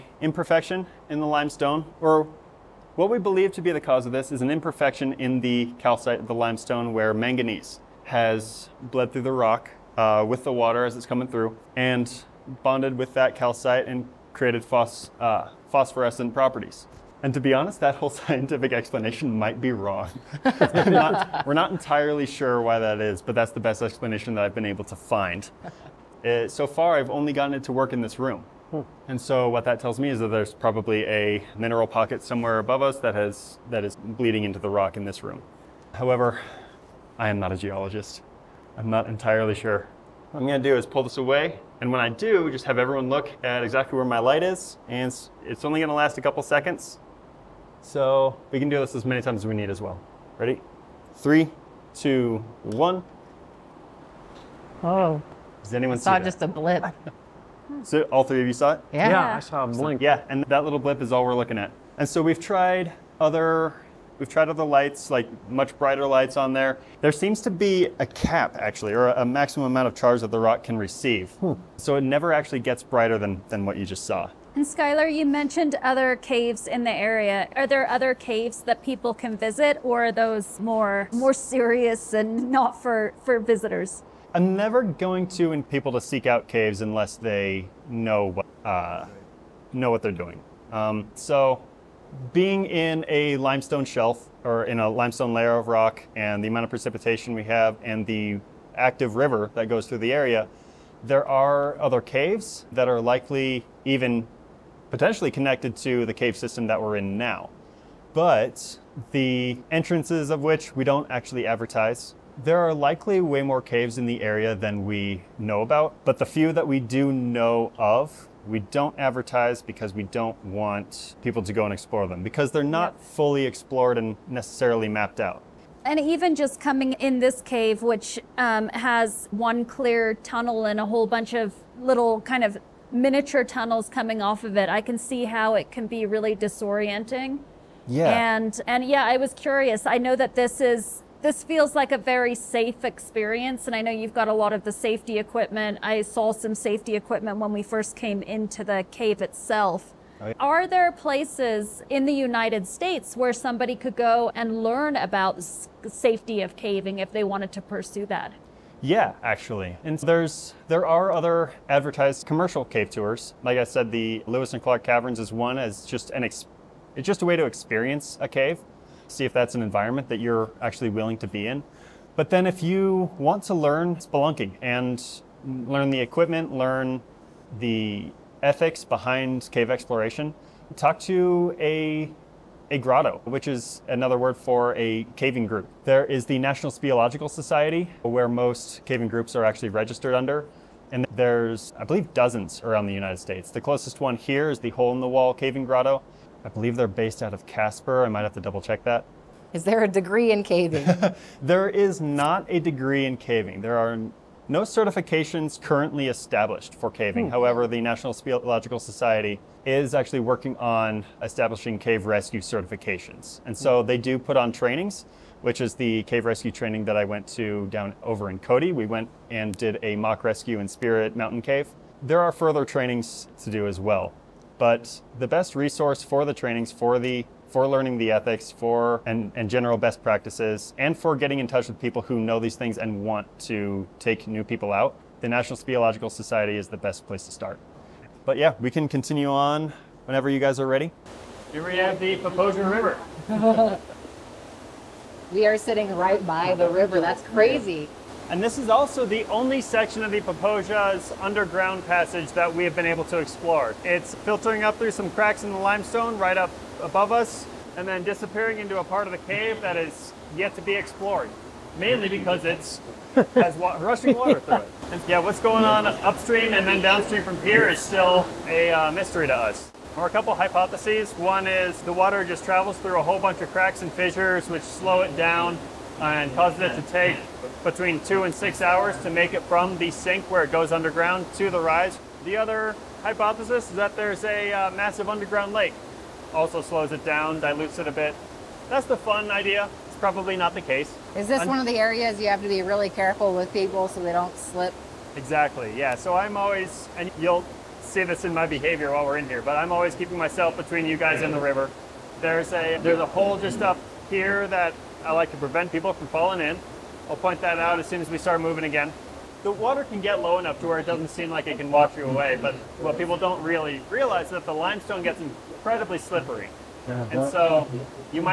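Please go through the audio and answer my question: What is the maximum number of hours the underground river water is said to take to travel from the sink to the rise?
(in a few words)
6.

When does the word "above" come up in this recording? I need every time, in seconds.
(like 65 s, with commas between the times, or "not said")
32 s, 256 s.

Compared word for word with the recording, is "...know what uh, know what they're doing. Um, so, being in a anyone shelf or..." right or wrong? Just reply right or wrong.
wrong.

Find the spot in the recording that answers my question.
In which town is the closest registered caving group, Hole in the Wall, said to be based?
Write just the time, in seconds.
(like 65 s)
197 s.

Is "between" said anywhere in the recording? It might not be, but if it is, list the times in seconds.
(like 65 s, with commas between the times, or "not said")
277 s, 300 s.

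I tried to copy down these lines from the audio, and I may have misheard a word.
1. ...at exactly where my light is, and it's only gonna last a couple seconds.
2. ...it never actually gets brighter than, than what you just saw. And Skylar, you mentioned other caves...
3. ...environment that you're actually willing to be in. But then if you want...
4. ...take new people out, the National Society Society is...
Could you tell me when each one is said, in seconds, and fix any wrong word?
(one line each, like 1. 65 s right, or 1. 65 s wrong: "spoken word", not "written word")
1. 43 s right
2. 71 s right
3. 169 s right
4. 233 s wrong: "Speleological", not "Society".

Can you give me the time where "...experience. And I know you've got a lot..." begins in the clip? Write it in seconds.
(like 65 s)
142 s.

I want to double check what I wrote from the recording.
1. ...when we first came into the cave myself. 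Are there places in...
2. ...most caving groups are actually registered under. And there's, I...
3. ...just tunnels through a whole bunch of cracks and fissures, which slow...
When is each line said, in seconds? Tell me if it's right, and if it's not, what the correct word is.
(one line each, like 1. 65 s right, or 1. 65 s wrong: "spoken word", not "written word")
1. 147 s wrong: "itself", not "myself"
2. 188 s right
3. 272 s wrong: "travels", not "tunnels".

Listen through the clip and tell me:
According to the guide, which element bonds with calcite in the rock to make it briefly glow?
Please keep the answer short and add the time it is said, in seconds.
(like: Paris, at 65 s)
manganese, at 7 s.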